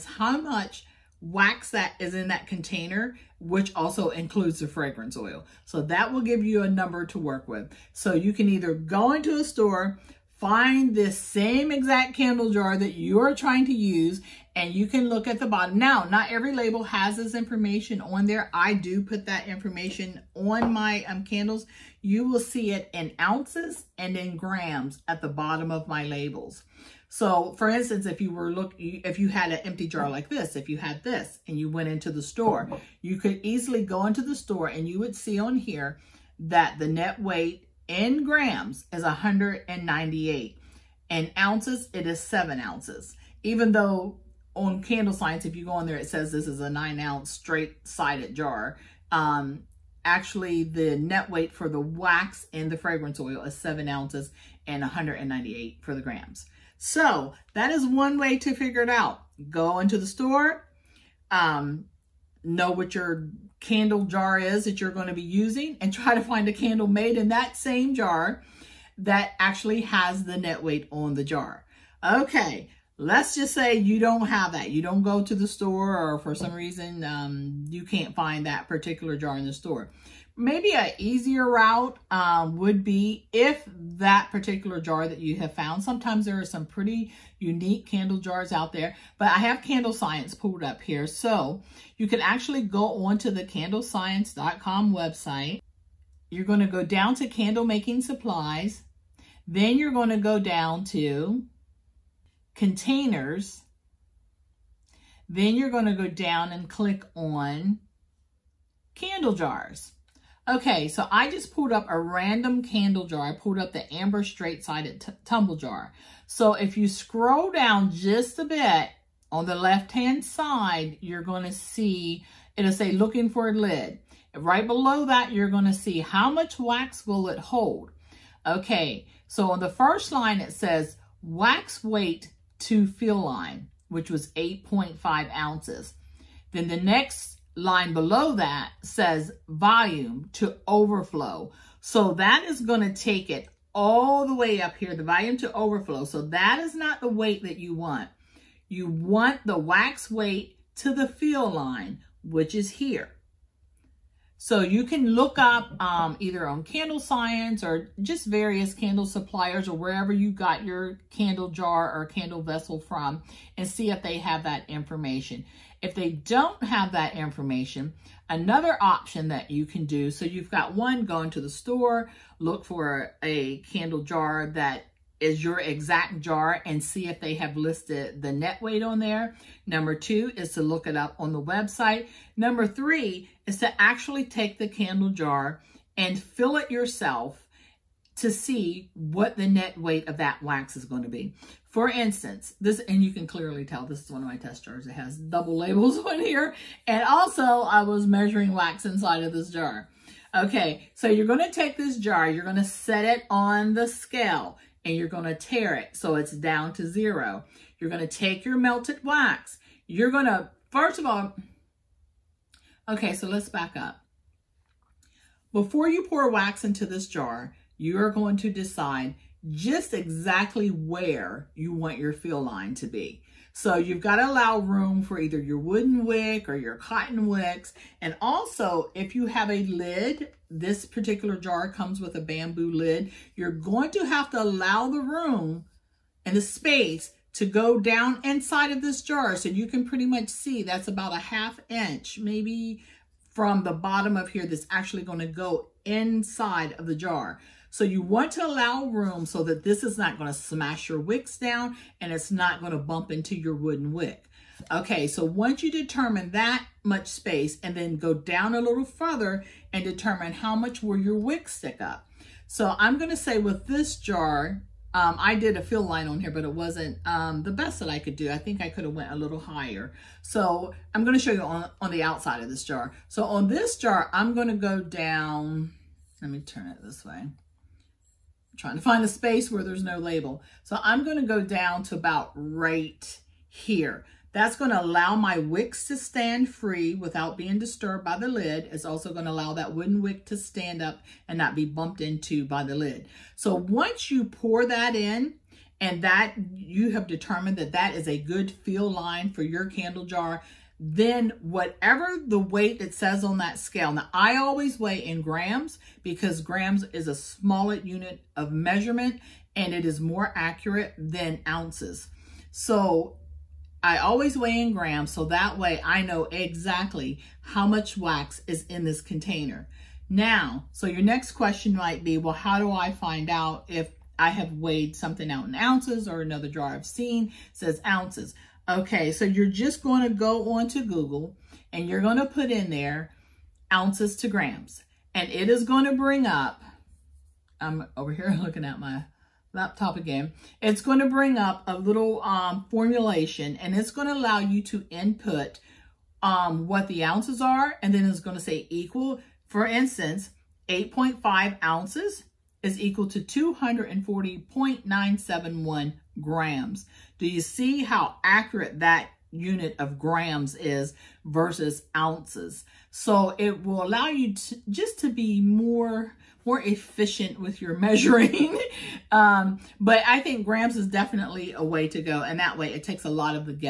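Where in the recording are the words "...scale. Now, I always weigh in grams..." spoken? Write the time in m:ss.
5:03.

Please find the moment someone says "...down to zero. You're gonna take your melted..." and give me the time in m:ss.
3:26.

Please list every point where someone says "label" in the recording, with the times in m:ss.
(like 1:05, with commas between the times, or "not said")
0:16, 0:26, 3:15, 4:39.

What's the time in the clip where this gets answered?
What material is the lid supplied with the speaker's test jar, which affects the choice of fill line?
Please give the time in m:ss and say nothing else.
3:52.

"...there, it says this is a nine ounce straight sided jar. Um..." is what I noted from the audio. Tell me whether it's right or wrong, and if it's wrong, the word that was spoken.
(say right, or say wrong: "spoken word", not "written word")
right.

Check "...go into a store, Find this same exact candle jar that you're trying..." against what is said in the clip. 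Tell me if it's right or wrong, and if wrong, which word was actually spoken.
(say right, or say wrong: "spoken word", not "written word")
right.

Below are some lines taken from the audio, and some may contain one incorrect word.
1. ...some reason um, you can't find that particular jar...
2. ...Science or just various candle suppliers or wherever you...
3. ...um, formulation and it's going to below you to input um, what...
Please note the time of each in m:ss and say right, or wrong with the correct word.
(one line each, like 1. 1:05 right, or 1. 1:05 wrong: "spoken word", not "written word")
1. 1:16 right
2. 2:36 right
3. 5:42 wrong: "allow", not "below".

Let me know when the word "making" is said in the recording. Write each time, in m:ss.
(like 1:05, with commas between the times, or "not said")
1:37.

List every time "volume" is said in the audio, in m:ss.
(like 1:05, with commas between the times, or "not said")
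2:19, 2:25.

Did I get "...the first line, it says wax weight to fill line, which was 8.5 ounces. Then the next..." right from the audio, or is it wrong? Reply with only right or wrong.
right.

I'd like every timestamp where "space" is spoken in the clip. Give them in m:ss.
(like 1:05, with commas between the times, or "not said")
3:56, 4:17, 4:39.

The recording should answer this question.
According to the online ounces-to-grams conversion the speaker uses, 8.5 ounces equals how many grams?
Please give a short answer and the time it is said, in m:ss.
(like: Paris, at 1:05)
240.971 grams, at 5:53.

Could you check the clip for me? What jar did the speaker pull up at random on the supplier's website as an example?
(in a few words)
Amber straight-sided tumble jar.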